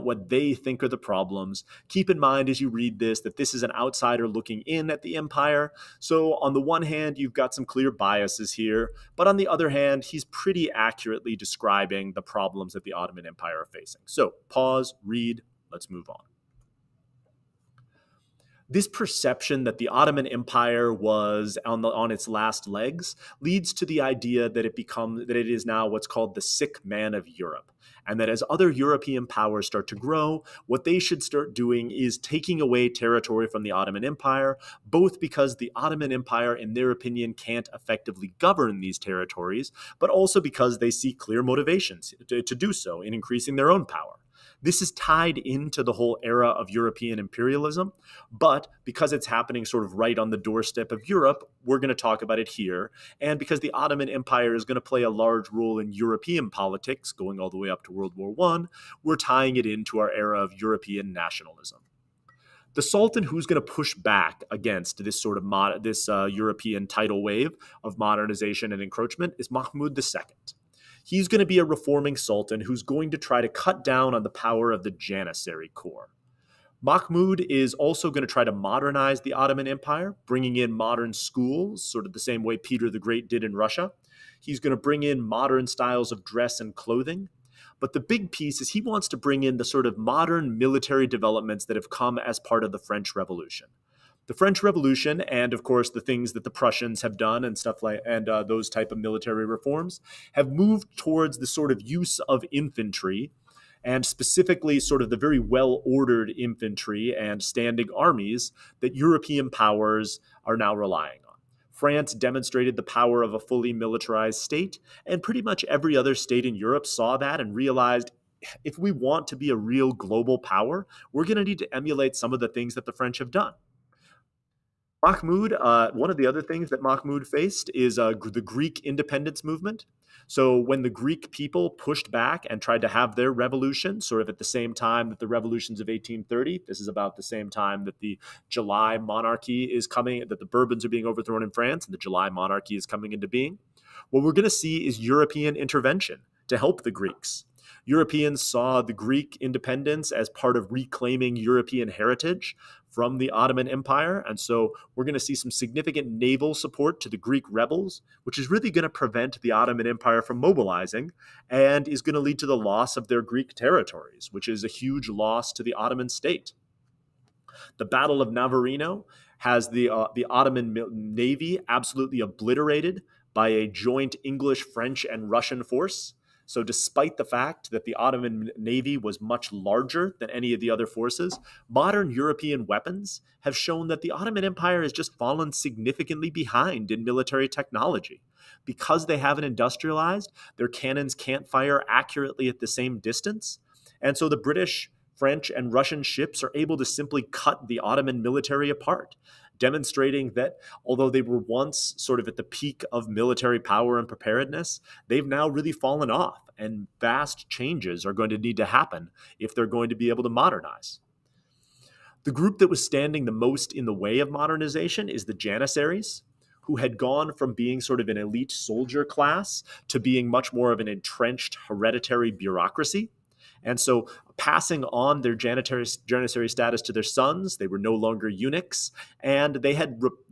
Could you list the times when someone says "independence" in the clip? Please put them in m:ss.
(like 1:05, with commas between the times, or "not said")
2:08, 2:29.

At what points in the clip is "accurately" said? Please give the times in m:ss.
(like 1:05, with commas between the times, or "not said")
0:10, 3:11.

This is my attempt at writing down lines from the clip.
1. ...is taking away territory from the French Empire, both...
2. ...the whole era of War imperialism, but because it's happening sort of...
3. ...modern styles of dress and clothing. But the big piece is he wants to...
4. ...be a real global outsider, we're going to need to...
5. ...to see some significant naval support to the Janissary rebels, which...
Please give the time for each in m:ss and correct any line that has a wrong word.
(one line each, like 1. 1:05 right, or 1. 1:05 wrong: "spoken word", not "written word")
1. 0:31 wrong: "Ottoman", not "French"
2. 0:45 wrong: "European", not "War"
3. 1:25 right
4. 1:59 wrong: "power", not "outsider"
5. 2:35 wrong: "Greek", not "Janissary".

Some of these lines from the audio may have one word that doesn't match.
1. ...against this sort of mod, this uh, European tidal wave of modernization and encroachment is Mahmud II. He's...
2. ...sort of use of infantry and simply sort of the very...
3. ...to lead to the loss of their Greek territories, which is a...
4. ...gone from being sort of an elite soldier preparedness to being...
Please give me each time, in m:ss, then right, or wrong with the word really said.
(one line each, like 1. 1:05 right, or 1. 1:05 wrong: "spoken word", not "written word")
1. 1:04 right
2. 1:41 wrong: "specifically", not "simply"
3. 2:42 right
4. 3:36 wrong: "class", not "preparedness".